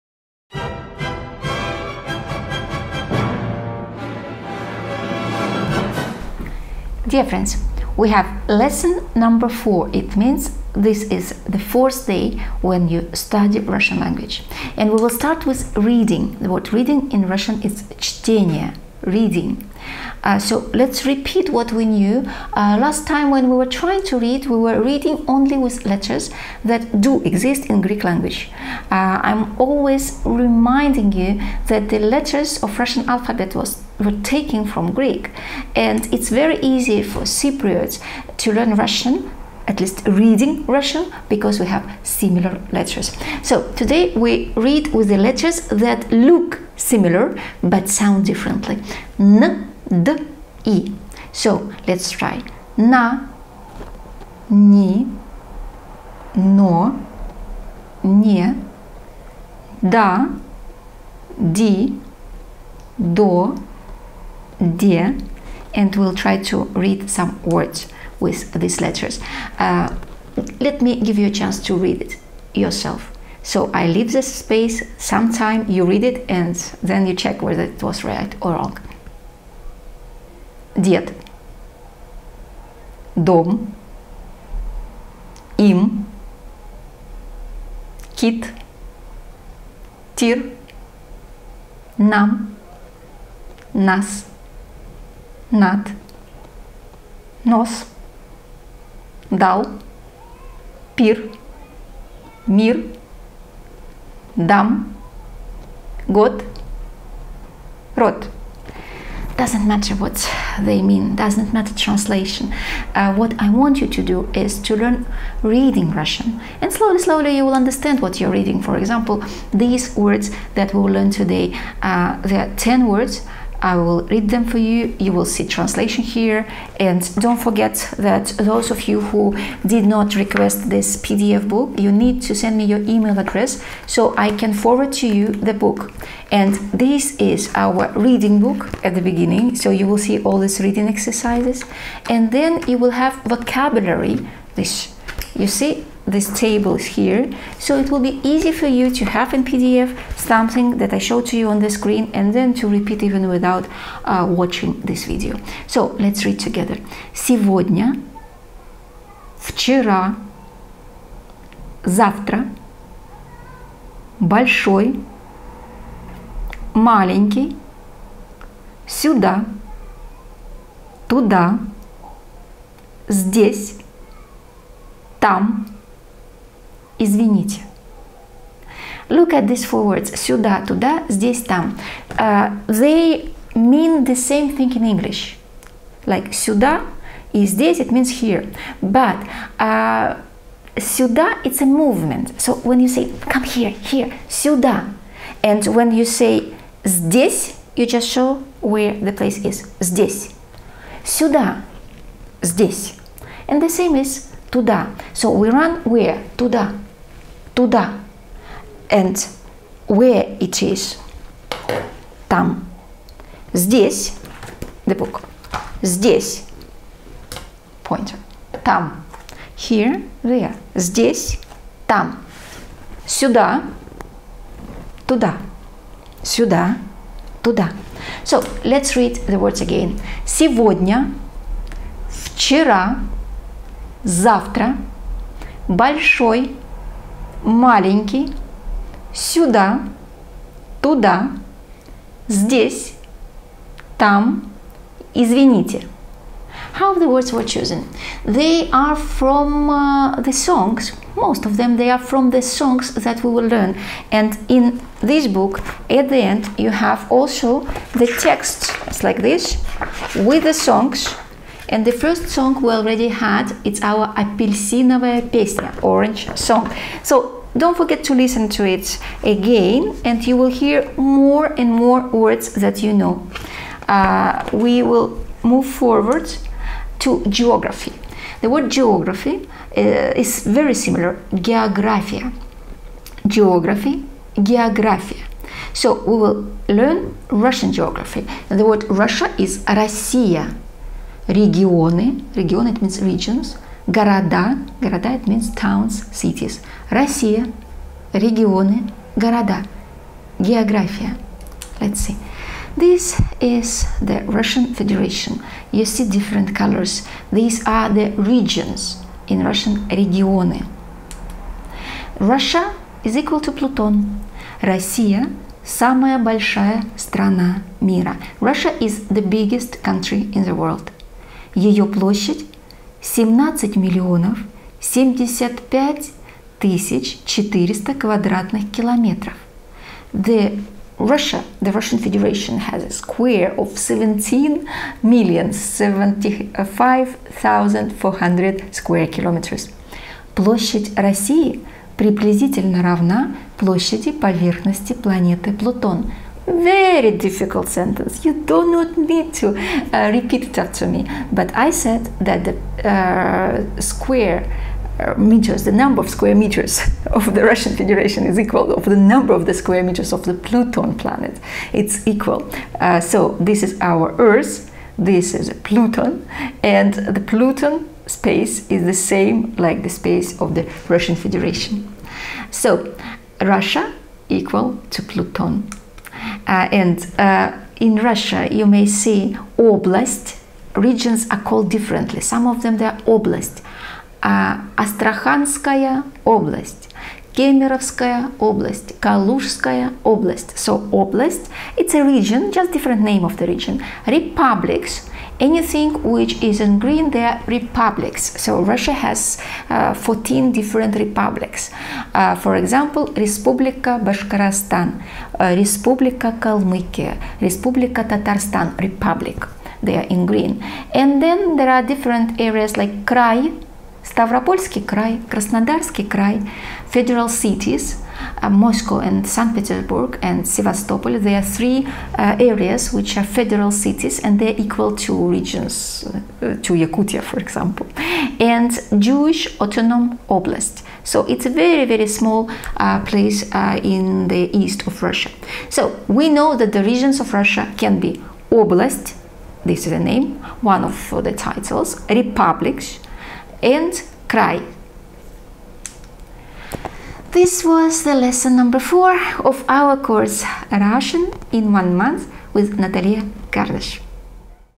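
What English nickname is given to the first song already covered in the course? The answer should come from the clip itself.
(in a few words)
orange song.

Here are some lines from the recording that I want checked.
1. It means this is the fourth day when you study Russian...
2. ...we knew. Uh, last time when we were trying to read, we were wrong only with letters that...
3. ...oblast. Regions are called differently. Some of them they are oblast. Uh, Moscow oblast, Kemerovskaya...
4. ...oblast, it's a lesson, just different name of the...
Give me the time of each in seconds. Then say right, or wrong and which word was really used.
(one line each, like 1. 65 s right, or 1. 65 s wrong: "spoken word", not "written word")
1. 9 s right
2. 21 s wrong: "reading", not "wrong"
3. 379 s wrong: "Astrakhanskaya", not "Moscow"
4. 390 s wrong: "region", not "lesson".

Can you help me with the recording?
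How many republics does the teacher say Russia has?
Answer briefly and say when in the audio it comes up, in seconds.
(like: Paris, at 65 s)
14, at 399 s.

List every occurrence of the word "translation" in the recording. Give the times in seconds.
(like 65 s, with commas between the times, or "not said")
111 s, 125 s.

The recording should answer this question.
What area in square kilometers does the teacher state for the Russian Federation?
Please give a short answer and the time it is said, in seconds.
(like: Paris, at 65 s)
17,075,400, at 323 s.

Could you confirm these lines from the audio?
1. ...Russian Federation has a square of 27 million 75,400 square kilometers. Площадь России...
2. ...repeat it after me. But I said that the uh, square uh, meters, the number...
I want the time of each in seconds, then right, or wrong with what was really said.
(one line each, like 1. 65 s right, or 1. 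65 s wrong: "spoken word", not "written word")
1. 331 s wrong: "17", not "27"
2. 350 s right.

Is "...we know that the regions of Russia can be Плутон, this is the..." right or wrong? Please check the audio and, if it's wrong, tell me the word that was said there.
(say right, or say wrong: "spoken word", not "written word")
wrong: "Oblast", not "Плутон".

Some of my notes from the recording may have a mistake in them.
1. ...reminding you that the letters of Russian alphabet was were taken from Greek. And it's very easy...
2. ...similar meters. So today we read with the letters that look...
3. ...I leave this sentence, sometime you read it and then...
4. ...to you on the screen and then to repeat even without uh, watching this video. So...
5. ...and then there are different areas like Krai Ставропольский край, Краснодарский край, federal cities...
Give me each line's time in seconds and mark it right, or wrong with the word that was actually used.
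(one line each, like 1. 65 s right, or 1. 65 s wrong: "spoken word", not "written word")
1. 30 s right
2. 42 s wrong: "letters", not "meters"
3. 73 s wrong: "space", not "sentence"
4. 151 s right
5. 410 s right.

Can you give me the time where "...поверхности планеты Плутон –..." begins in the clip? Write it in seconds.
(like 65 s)
344 s.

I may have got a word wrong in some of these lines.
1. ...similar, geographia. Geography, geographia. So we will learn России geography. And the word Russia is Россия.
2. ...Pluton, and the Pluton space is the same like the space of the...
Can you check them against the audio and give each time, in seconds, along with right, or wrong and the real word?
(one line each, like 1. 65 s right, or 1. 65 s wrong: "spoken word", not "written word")
1. 280 s wrong: "Russian", not "России"
2. 365 s right.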